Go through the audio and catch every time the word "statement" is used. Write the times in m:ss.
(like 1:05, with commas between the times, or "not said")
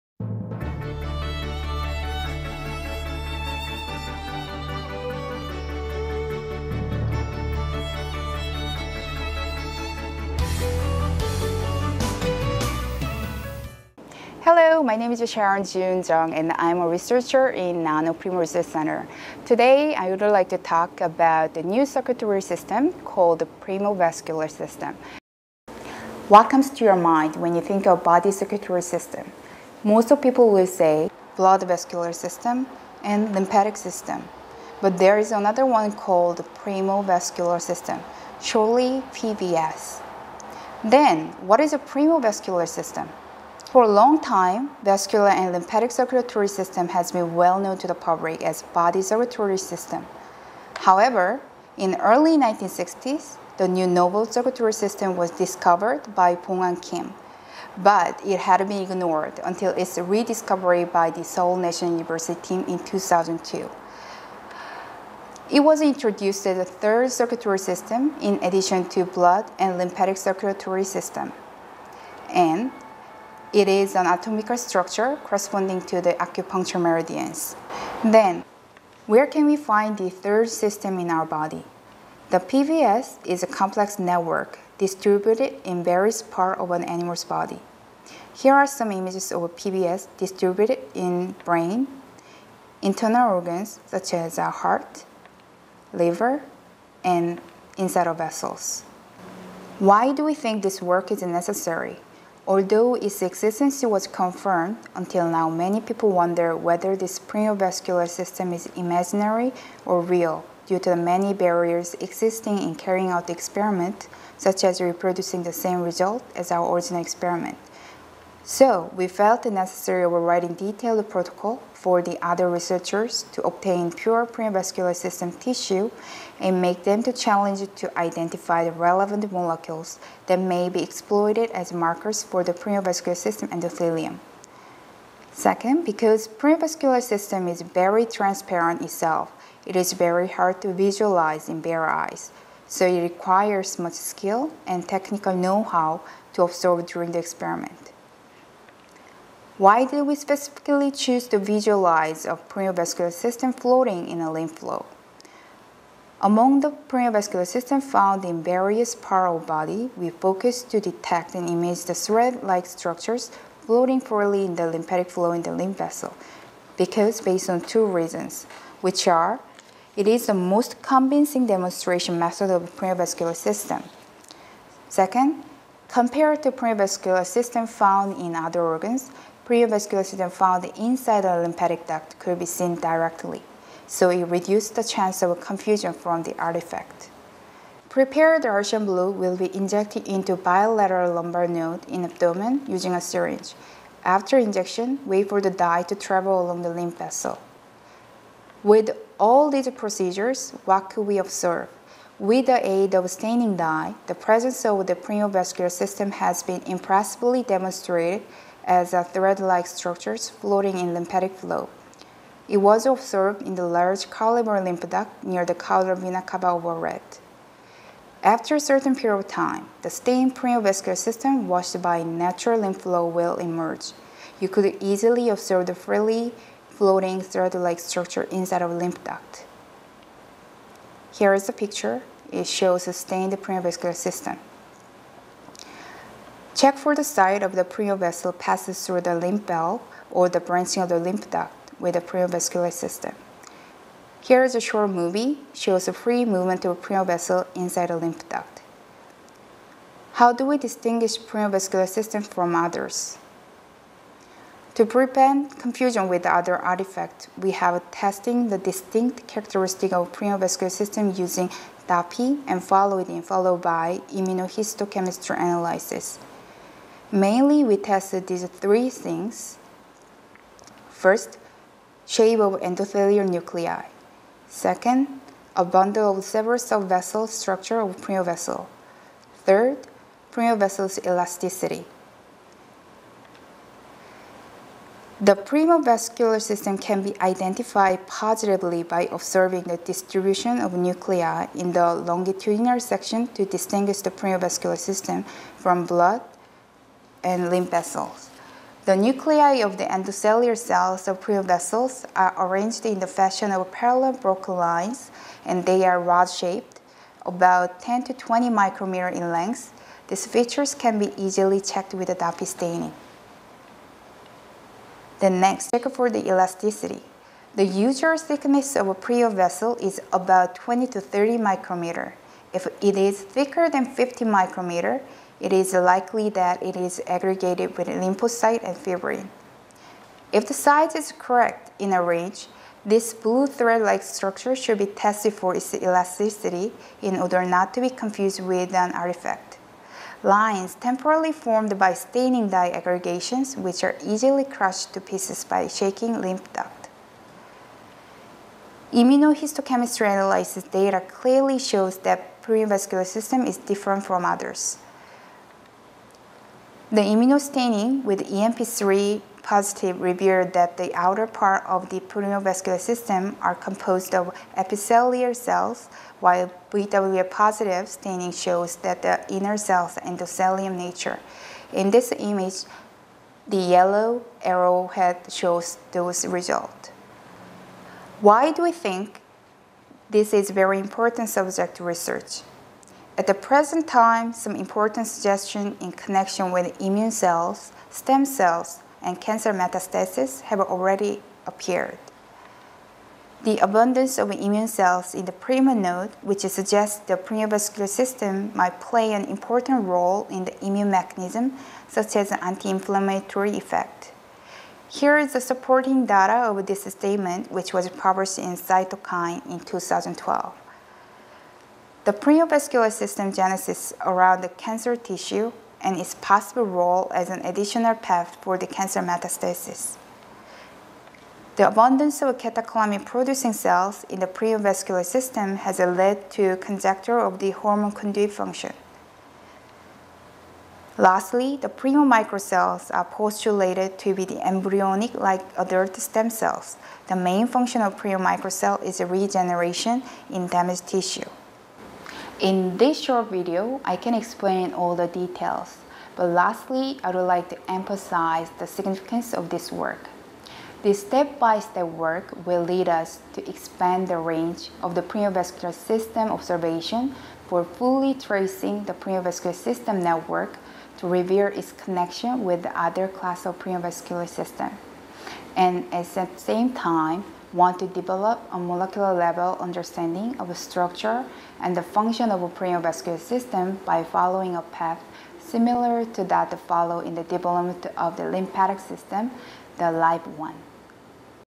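6:46.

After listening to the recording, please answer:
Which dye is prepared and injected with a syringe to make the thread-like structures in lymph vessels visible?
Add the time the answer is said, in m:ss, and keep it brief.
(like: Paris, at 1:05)
Prussian blue, at 3:08.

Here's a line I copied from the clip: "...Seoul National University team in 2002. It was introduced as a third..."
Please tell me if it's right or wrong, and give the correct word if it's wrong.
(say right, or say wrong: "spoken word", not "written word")
right.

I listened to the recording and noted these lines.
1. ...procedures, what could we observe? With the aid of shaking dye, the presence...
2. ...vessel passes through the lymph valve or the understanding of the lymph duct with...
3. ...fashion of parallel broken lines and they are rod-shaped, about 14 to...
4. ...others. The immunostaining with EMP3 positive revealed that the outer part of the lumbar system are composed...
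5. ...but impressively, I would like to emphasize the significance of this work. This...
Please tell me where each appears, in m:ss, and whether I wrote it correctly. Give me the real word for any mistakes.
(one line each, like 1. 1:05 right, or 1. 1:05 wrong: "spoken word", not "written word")
1. 3:19 wrong: "staining", not "shaking"
2. 3:57 wrong: "branching", not "understanding"
3. 5:03 wrong: "10", not "14"
4. 5:54 wrong: "primovascular", not "lumbar"
5. 7:26 wrong: "lastly", not "impressively".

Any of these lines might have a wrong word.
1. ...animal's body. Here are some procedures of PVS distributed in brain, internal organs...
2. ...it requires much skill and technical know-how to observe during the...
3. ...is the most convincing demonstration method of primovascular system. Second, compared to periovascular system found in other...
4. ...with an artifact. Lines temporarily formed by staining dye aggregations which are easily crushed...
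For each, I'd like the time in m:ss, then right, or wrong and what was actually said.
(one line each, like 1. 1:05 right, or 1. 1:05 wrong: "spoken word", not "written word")
1. 1:26 wrong: "images", not "procedures"
2. 2:22 right
3. 2:50 right
4. 5:38 right.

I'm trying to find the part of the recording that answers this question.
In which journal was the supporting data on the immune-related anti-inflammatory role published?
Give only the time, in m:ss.
6:48.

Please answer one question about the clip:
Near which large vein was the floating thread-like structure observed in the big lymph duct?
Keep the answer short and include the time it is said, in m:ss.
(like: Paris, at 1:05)
caudal vena cava, at 3:35.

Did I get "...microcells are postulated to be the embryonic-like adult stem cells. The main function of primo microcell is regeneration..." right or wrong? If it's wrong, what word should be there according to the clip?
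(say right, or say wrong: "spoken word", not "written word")
right.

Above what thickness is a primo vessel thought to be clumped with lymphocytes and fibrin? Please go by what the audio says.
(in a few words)
50 micrometers.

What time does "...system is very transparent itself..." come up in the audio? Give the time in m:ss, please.
2:17.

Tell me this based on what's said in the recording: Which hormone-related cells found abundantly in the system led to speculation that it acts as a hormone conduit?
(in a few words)
catecholamine-producing cells.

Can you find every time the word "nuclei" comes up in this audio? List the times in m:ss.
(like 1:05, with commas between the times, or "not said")
4:33, 4:50, 4:58.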